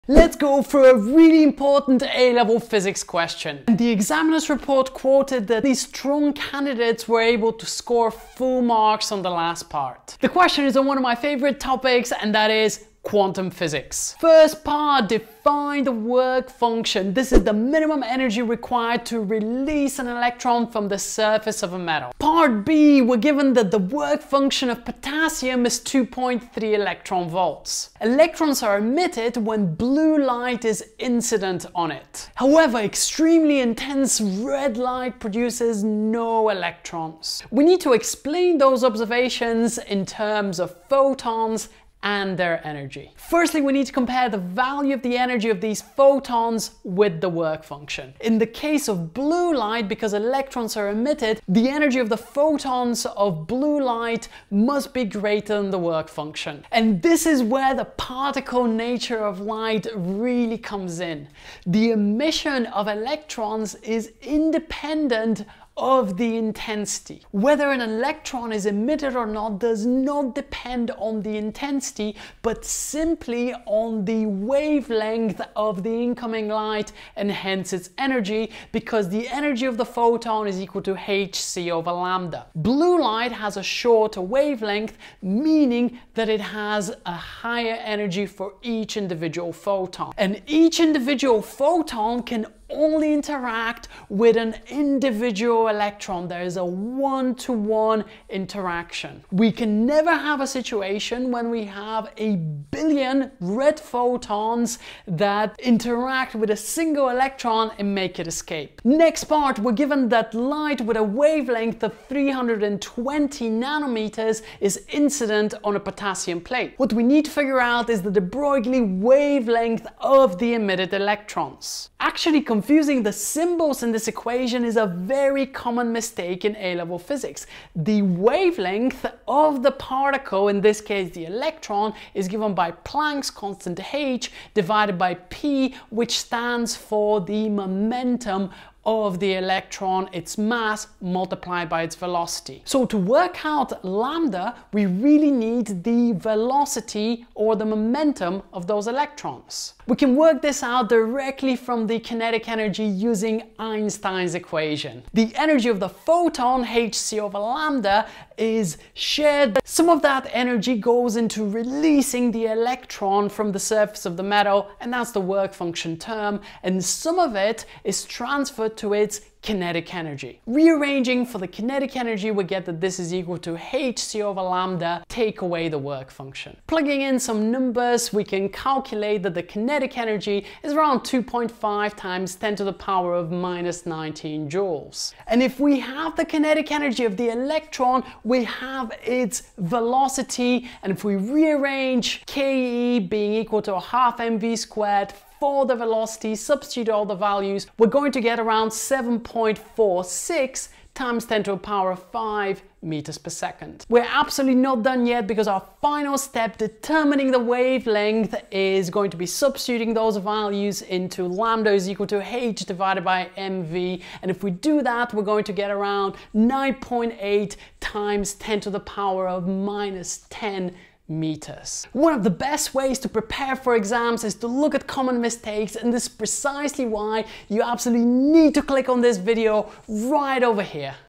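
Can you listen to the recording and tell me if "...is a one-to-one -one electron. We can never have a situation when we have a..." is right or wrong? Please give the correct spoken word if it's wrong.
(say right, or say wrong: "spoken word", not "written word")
wrong: "interaction", not "electron".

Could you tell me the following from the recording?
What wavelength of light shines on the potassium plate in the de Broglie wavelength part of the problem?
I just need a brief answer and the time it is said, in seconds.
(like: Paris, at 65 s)
320 nanometers, at 112 s.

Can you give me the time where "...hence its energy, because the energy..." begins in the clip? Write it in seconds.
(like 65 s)
77 s.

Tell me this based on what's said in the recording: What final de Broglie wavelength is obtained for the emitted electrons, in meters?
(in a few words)
9.8 x 10^-10 meters.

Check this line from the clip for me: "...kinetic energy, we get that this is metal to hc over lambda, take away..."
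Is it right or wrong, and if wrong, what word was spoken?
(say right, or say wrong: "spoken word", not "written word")
wrong: "equal", not "metal".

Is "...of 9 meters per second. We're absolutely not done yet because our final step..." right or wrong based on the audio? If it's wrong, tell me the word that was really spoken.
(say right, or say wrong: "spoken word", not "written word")
wrong: "5", not "9".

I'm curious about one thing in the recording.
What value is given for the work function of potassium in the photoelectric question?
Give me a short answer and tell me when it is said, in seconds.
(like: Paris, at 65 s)
2.3 electron volts, at 25 s.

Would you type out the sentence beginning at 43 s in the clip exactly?
Firstly, we need to compare the value of the energy of these photons with the work function.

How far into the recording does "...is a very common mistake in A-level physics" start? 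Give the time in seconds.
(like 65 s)
124 s.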